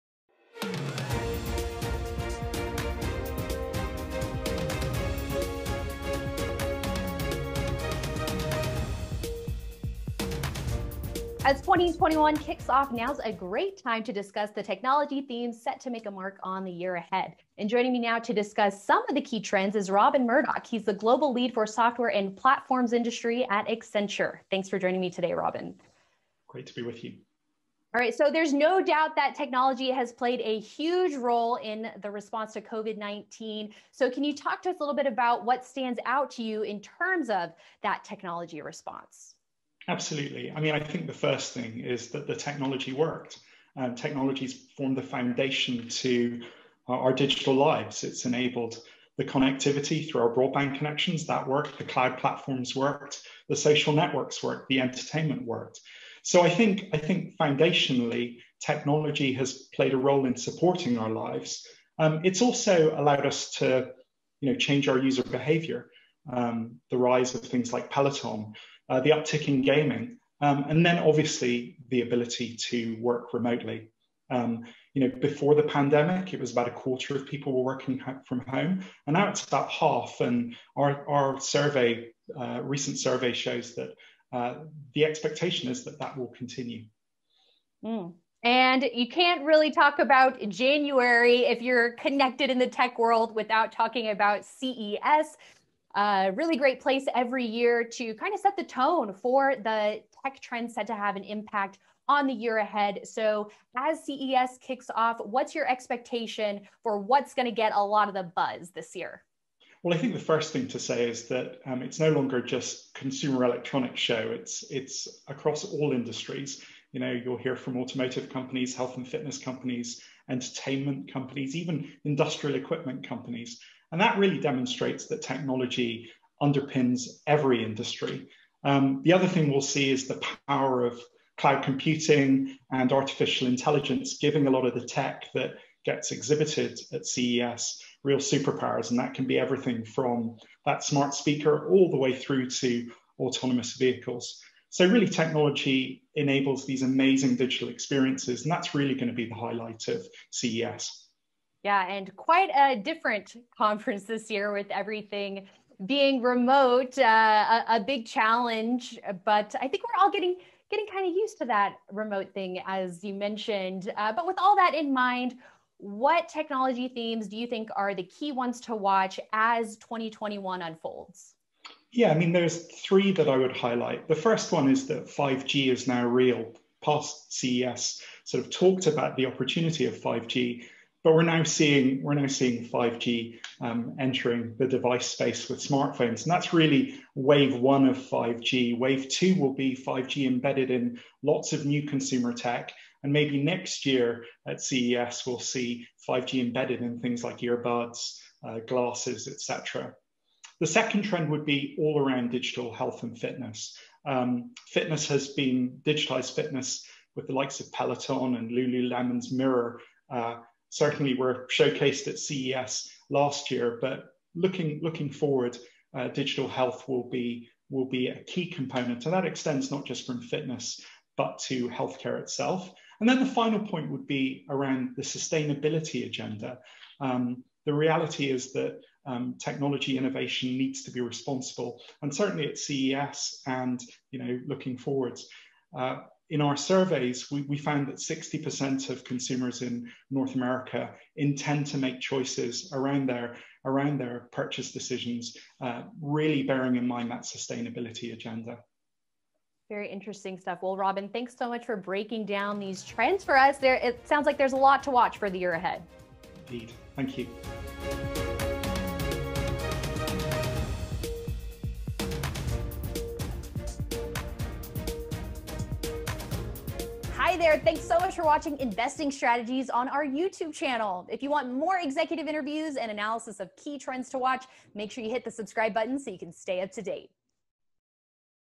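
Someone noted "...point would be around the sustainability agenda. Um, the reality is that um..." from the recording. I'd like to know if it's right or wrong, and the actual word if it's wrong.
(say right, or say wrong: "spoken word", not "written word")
right.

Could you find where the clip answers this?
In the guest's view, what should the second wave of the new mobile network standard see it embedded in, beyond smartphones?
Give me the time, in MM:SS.
03:11.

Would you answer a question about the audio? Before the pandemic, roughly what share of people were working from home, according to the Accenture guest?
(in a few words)
a quarter.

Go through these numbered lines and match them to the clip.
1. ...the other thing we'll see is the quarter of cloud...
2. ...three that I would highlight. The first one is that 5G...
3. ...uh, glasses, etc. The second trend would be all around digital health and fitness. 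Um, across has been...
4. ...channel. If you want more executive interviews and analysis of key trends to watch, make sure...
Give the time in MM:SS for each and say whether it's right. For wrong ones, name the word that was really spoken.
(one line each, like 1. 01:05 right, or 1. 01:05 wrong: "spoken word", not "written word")
1. 02:09 wrong: "power", not "quarter"
2. 02:52 right
3. 03:18 wrong: "fitness", not "across"
4. 04:30 right.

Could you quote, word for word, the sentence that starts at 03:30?
Uh, certainly were showcased at CES last year, but looking looking forward, uh, digital health will be will be a key component.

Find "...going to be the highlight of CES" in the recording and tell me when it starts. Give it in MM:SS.
02:28.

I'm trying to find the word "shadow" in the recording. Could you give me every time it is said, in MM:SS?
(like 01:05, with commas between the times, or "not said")
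not said.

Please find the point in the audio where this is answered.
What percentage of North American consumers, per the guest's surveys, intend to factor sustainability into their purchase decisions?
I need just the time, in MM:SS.
03:57.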